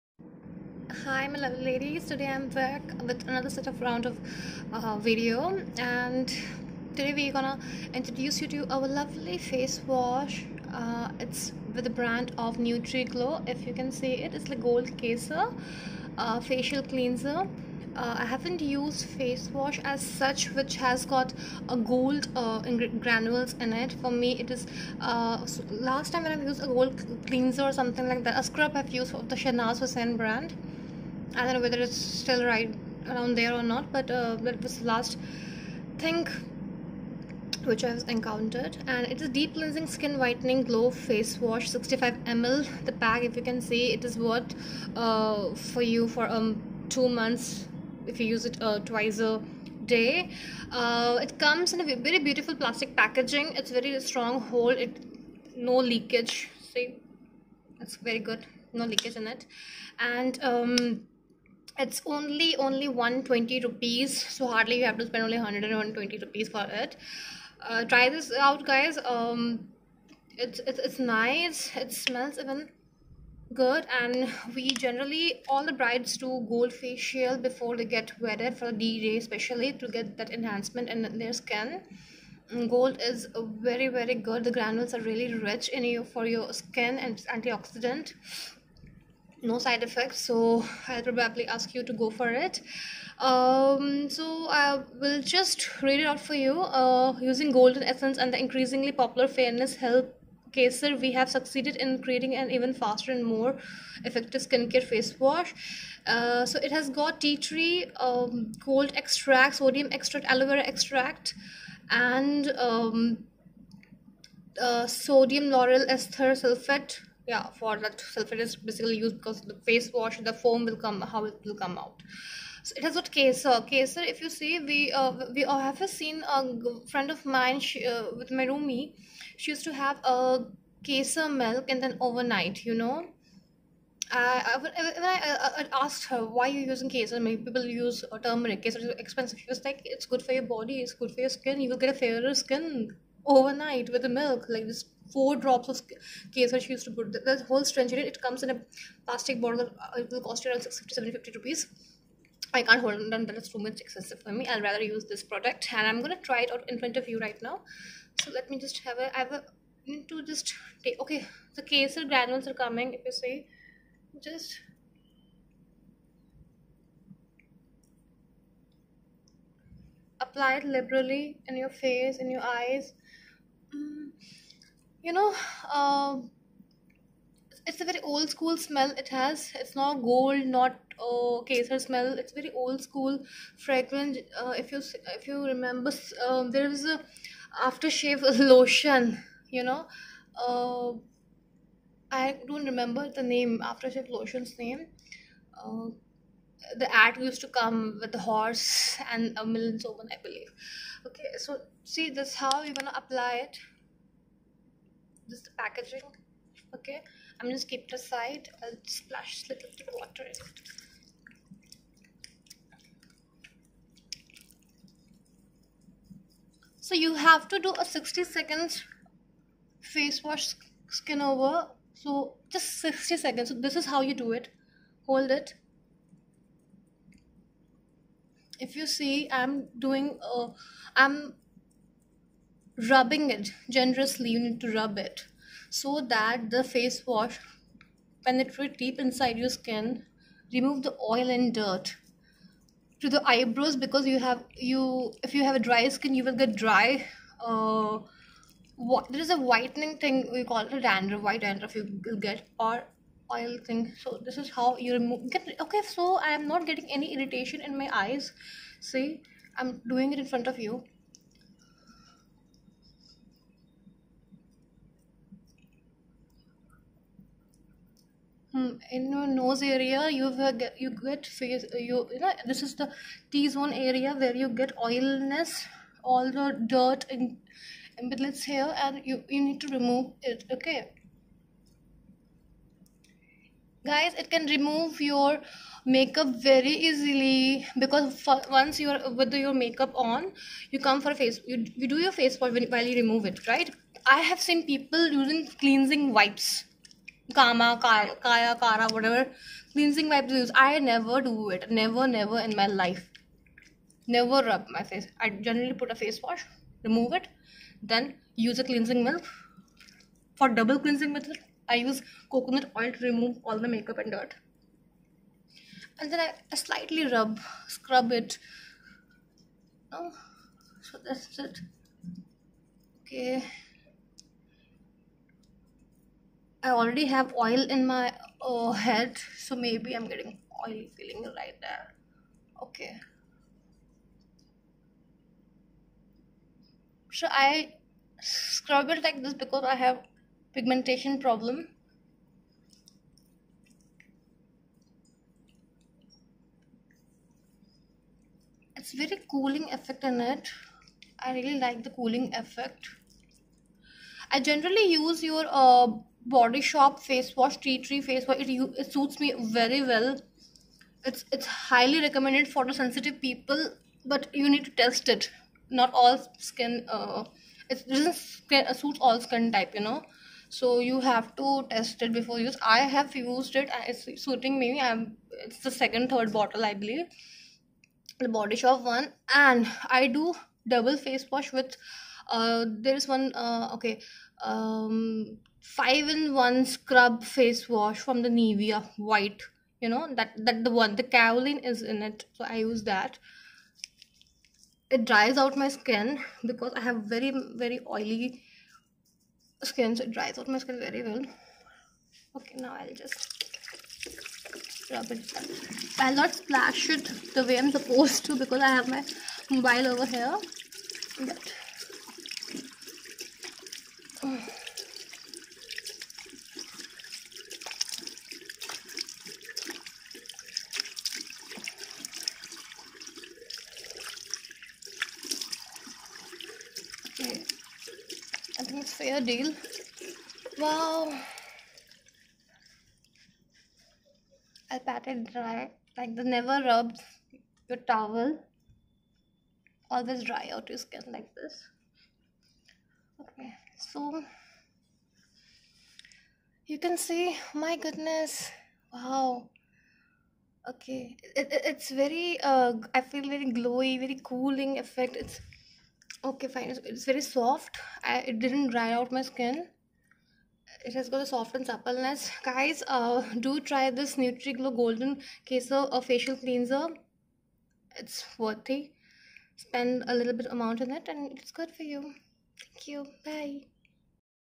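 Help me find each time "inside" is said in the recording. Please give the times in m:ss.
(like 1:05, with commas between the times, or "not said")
3:59.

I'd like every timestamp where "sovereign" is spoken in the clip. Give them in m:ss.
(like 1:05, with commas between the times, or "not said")
3:19.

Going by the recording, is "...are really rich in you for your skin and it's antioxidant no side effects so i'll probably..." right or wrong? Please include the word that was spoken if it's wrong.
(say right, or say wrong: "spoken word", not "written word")
right.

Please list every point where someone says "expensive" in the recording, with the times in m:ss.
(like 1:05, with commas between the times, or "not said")
2:18, 2:33.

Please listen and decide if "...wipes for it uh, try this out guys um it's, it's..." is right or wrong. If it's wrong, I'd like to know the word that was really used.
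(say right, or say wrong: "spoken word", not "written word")
wrong: "rupees", not "wipes".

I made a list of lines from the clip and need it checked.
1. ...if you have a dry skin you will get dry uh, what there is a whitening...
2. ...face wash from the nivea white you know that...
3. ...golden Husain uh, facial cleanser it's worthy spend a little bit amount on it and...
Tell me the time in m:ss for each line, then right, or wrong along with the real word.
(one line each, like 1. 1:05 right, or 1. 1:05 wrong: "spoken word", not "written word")
1. 4:05 right
2. 6:27 right
3. 7:44 wrong: "Kesar", not "Husain".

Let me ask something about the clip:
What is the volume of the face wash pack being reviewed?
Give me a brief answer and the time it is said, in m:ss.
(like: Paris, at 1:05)
65 ml, at 0:41.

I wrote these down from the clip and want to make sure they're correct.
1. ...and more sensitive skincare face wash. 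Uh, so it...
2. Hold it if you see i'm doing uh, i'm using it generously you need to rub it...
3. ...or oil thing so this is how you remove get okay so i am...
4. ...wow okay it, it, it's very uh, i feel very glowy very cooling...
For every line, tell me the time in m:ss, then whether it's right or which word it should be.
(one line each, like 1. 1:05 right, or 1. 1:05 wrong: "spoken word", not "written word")
1. 1:43 wrong: "effective", not "sensitive"
2. 3:45 wrong: "rubbing", not "using"
3. 4:12 right
4. 7:28 right.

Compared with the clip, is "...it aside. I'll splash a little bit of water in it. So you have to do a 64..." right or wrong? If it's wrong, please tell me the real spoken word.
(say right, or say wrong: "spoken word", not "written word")
wrong: "60", not "64".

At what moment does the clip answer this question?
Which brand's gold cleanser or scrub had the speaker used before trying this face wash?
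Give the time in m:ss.
0:29.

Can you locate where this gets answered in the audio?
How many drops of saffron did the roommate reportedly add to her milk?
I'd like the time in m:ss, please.
2:25.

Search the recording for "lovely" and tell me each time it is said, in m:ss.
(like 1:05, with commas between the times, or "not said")
0:01, 0:08.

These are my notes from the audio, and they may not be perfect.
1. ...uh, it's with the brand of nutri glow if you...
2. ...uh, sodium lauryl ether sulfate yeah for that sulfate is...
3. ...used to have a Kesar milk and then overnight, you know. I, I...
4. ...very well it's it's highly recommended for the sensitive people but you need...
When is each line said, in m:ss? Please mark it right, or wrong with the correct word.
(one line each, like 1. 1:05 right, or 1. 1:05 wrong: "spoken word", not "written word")
1. 0:10 right
2. 1:54 right
3. 2:09 right
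4. 5:59 right.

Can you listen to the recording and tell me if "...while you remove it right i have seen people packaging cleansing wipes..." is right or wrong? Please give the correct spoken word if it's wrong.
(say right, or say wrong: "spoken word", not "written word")
wrong: "using", not "packaging".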